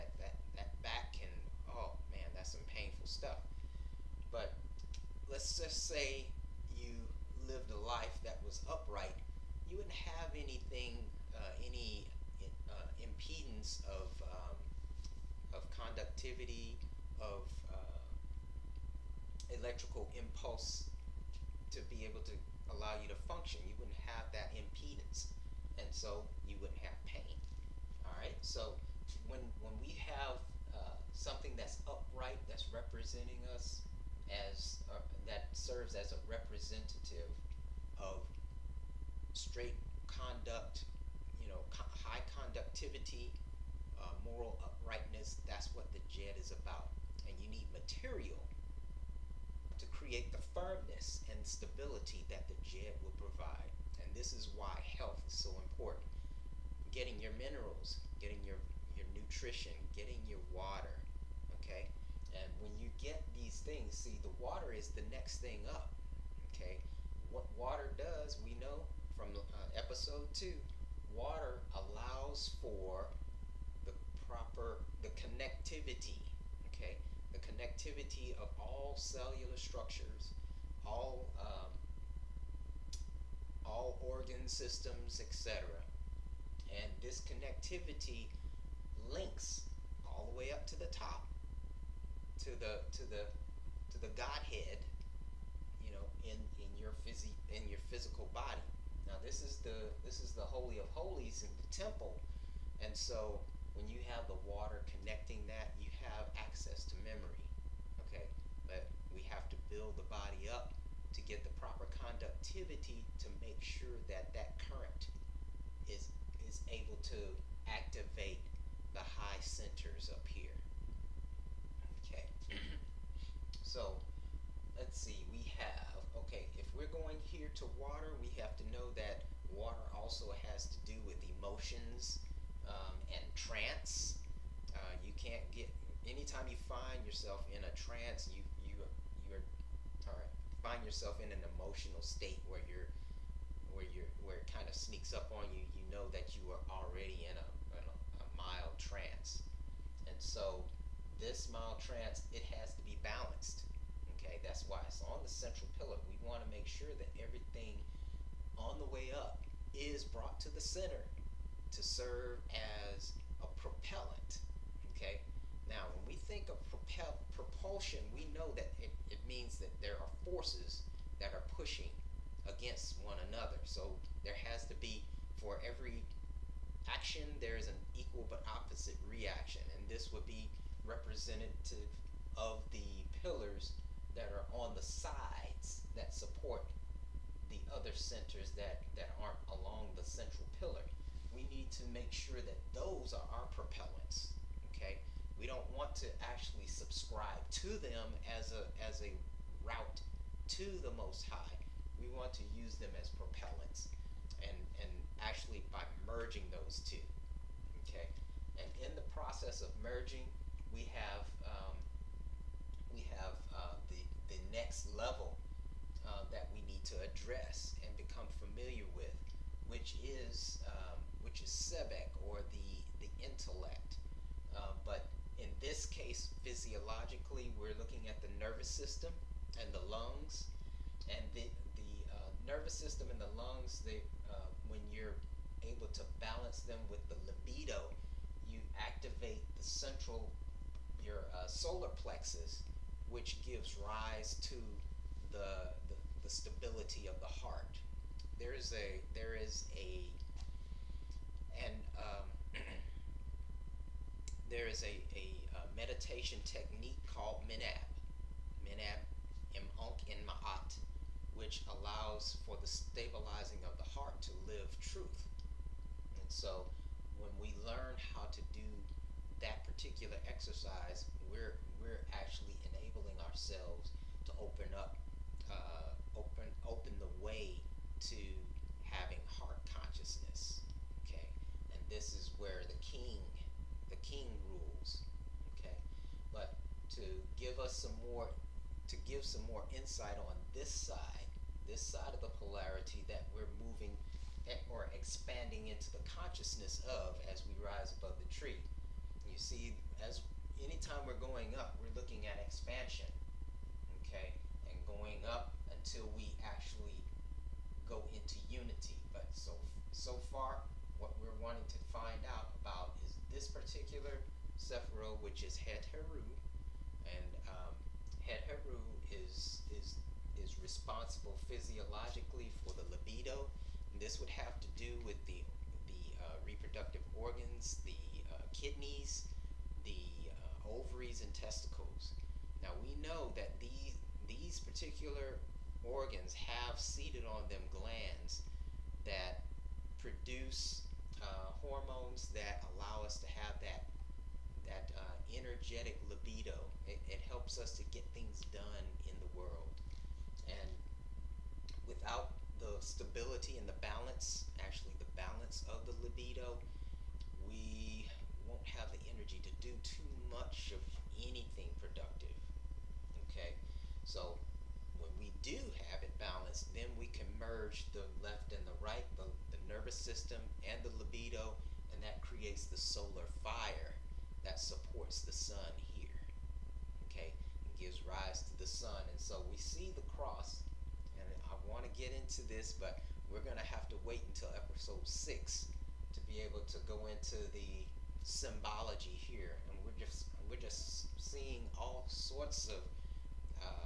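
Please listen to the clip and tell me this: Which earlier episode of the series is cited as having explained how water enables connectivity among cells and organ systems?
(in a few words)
Episode 2.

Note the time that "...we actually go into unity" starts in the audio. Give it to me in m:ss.
5:06.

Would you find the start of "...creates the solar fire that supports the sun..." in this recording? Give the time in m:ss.
6:12.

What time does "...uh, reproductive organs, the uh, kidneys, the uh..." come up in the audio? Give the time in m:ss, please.
5:26.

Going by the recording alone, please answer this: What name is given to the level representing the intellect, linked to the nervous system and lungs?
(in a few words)
Sebek.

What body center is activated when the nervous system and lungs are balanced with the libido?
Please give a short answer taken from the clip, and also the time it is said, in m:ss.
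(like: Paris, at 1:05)
Solar plexus, at 4:01.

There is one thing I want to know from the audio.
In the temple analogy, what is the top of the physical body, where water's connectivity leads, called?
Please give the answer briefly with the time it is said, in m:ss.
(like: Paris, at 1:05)
Holy of holies, at 1:40.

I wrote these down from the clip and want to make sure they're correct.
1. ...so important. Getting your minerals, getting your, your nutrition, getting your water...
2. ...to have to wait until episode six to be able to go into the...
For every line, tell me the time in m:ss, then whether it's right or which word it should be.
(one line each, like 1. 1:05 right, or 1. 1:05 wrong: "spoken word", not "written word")
1. 0:55 right
2. 6:23 right.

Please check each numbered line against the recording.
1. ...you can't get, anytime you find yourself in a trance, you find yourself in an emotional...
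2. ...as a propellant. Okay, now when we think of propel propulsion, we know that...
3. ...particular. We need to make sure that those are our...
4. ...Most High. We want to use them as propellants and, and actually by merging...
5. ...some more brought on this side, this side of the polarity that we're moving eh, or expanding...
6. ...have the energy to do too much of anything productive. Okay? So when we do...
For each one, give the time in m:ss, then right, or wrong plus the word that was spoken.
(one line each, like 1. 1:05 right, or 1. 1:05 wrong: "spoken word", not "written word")
1. 2:15 right
2. 2:42 right
3. 3:10 wrong: "pillar", not "particular"
4. 3:20 right
5. 4:49 wrong: "insight", not "brought"
6. 5:58 right.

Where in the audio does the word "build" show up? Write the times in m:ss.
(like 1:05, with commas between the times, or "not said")
1:49.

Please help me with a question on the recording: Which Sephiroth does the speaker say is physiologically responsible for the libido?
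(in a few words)
Het.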